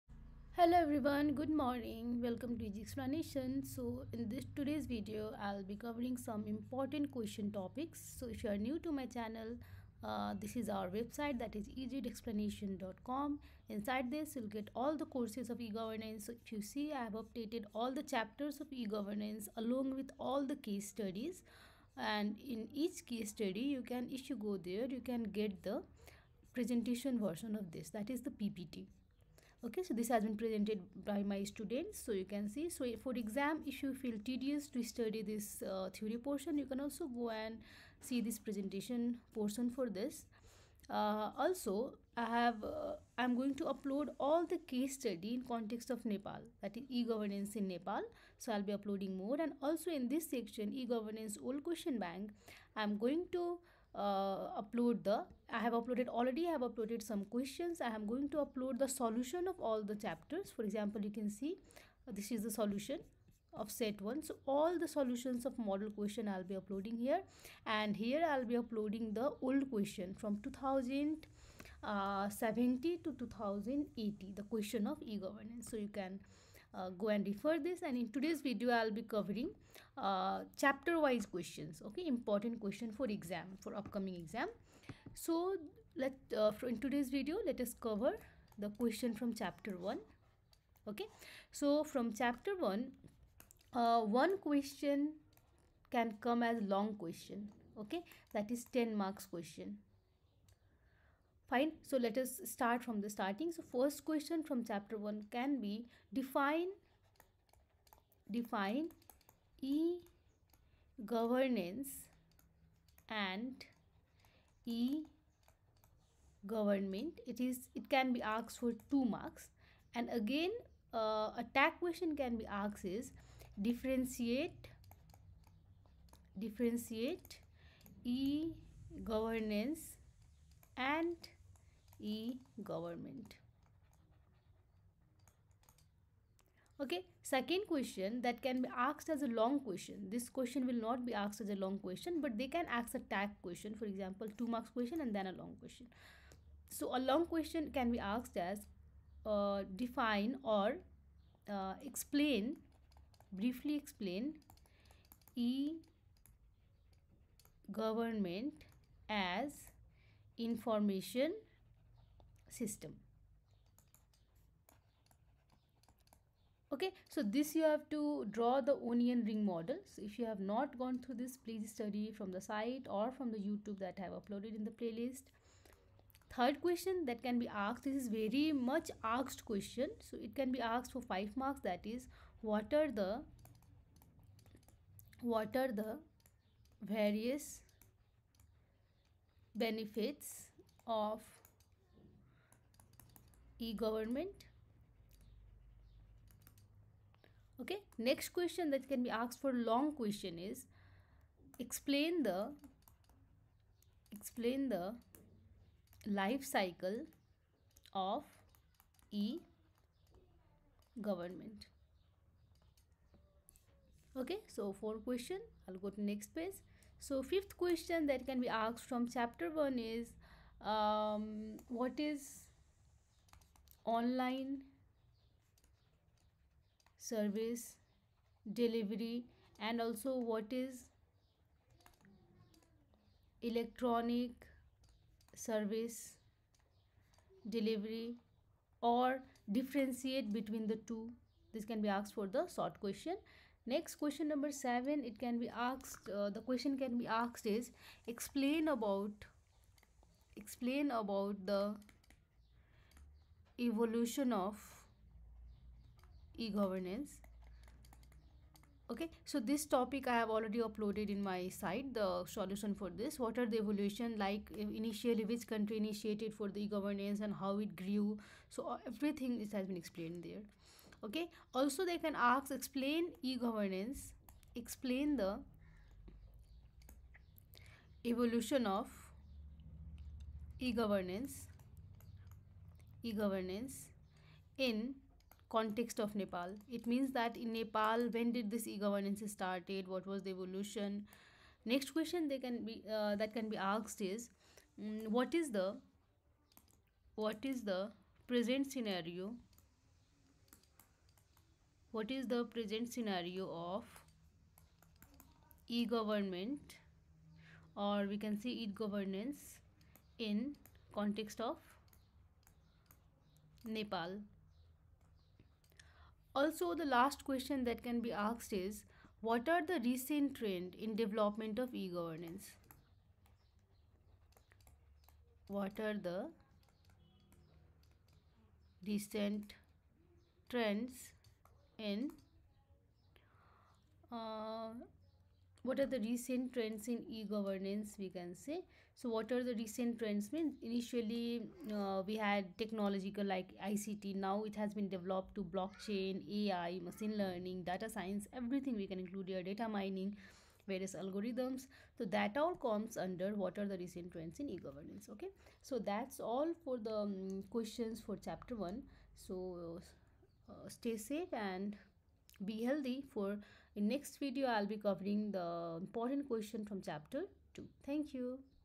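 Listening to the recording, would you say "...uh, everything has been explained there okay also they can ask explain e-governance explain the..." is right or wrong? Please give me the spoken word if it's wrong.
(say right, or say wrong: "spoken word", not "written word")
right.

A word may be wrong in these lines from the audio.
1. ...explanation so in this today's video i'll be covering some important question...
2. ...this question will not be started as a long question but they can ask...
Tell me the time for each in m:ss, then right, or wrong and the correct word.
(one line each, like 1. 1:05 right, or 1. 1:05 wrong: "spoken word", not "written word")
1. 0:02 right
2. 2:20 wrong: "asked", not "started".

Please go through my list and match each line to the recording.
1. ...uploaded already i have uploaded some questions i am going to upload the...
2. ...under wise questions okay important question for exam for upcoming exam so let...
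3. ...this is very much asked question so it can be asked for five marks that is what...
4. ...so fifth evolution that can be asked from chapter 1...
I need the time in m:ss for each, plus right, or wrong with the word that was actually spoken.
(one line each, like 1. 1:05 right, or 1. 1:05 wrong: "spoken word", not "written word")
1. 0:55 right
2. 1:20 wrong: "chapter", not "under"
3. 2:57 right
4. 3:37 wrong: "question", not "evolution".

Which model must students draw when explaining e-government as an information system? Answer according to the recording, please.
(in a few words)
Onion ring model.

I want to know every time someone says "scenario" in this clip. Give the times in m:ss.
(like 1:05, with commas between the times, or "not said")
4:58, 5:02.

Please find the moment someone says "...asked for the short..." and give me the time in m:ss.
4:01.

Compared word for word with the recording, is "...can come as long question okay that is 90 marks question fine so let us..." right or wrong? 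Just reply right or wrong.
wrong.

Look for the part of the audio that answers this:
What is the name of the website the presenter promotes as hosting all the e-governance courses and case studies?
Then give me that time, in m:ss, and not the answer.
0:11.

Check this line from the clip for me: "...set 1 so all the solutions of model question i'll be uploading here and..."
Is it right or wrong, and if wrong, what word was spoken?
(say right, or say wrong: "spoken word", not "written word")
right.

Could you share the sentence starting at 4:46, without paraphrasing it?
It means that in Nepal, when did this e-governance started?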